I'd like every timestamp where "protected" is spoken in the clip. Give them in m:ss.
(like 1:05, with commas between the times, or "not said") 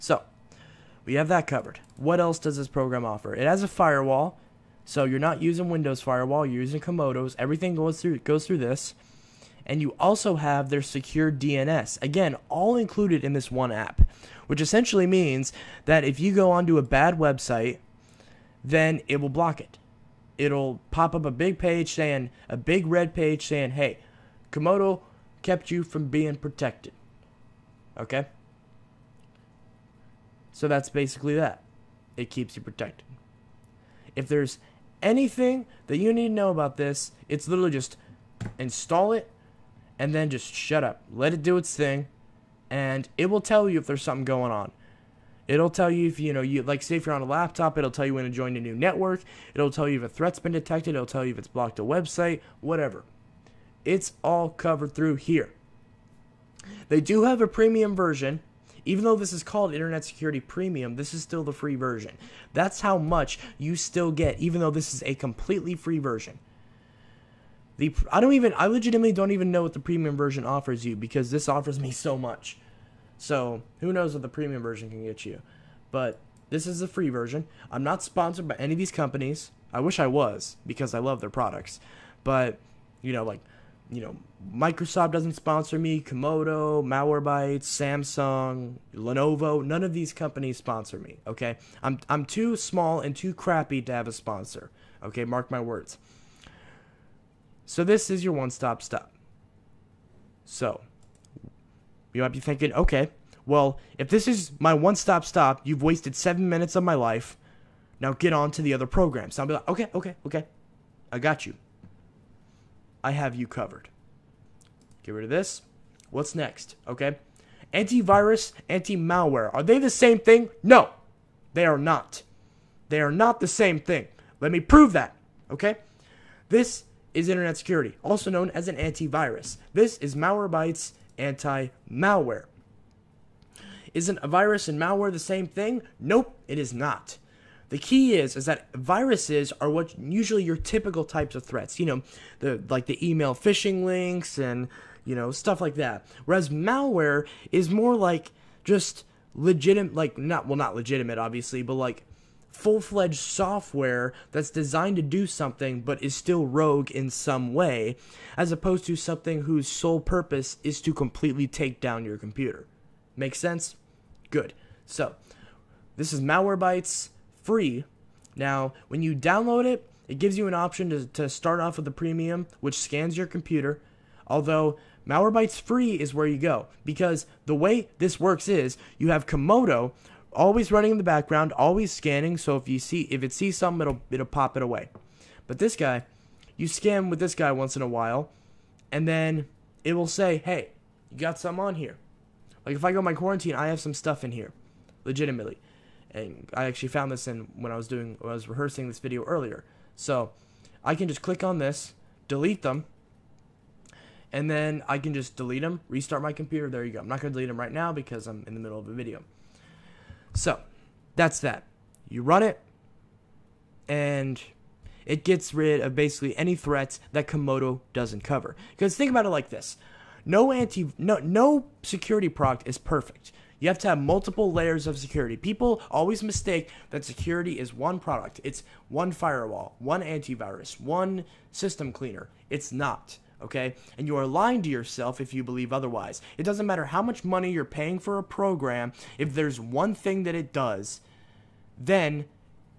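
0:26, 0:32.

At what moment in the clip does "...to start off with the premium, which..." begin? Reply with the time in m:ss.
2:51.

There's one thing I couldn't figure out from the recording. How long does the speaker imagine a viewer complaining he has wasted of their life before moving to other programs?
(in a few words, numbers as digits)
7 minutes.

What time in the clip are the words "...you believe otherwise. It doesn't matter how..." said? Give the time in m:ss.
3:55.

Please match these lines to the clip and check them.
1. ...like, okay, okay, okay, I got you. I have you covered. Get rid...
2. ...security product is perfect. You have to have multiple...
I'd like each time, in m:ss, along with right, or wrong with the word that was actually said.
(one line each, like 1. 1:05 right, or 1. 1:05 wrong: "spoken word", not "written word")
1. 1:49 right
2. 3:41 right.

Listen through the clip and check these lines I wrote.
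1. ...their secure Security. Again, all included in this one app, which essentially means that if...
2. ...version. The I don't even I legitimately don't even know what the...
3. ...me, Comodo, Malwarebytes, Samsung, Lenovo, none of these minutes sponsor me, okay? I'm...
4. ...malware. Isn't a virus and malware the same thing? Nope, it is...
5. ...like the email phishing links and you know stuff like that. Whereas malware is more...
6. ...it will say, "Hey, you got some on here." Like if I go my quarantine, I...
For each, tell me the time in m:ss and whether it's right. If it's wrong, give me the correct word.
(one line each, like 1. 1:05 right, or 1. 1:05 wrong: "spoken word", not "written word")
1. 0:10 wrong: "DNS", not "Security"
2. 1:05 right
3. 1:25 wrong: "companies", not "minutes"
4. 2:11 right
5. 2:22 right
6. 3:09 right.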